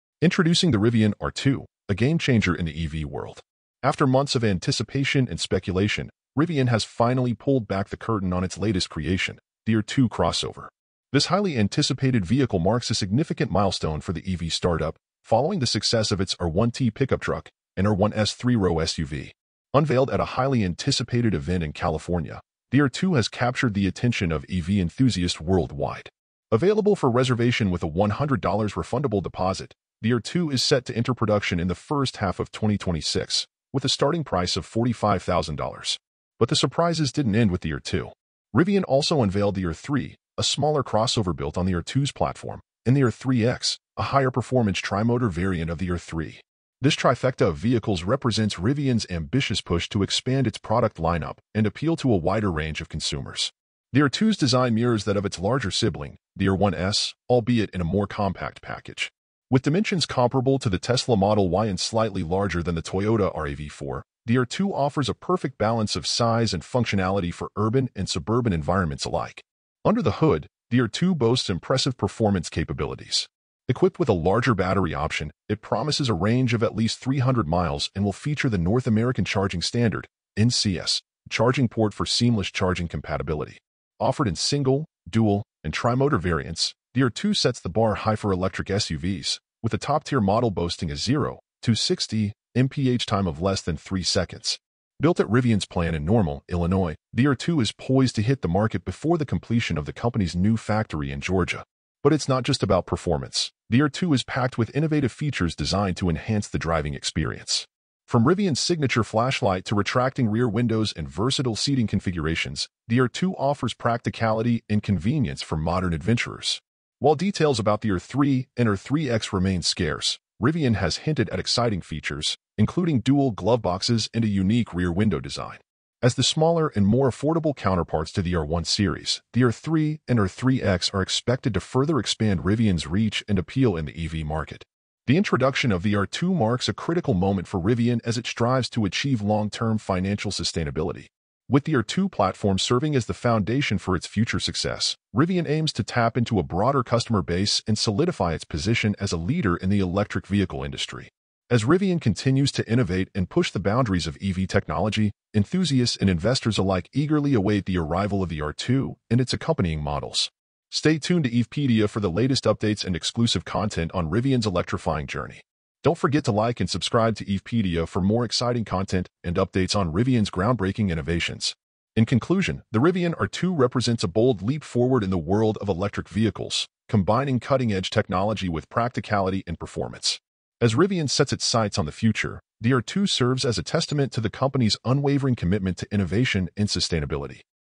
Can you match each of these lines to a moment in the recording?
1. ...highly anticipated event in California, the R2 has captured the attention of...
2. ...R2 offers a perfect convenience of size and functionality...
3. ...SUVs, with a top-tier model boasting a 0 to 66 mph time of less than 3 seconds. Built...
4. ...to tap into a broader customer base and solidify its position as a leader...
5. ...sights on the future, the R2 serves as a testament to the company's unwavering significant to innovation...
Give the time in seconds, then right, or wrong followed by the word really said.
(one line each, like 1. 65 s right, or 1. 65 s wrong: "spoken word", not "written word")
1. 20 s right
2. 64 s wrong: "balance", not "convenience"
3. 88 s wrong: "60", not "66"
4. 145 s right
5. 181 s wrong: "commitment", not "significant".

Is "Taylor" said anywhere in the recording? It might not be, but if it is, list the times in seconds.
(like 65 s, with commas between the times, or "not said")
not said.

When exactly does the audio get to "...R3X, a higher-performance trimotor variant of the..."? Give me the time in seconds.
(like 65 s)
43 s.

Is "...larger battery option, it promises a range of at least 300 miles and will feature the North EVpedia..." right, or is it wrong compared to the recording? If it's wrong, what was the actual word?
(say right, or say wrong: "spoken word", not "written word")
wrong: "American", not "EVpedia".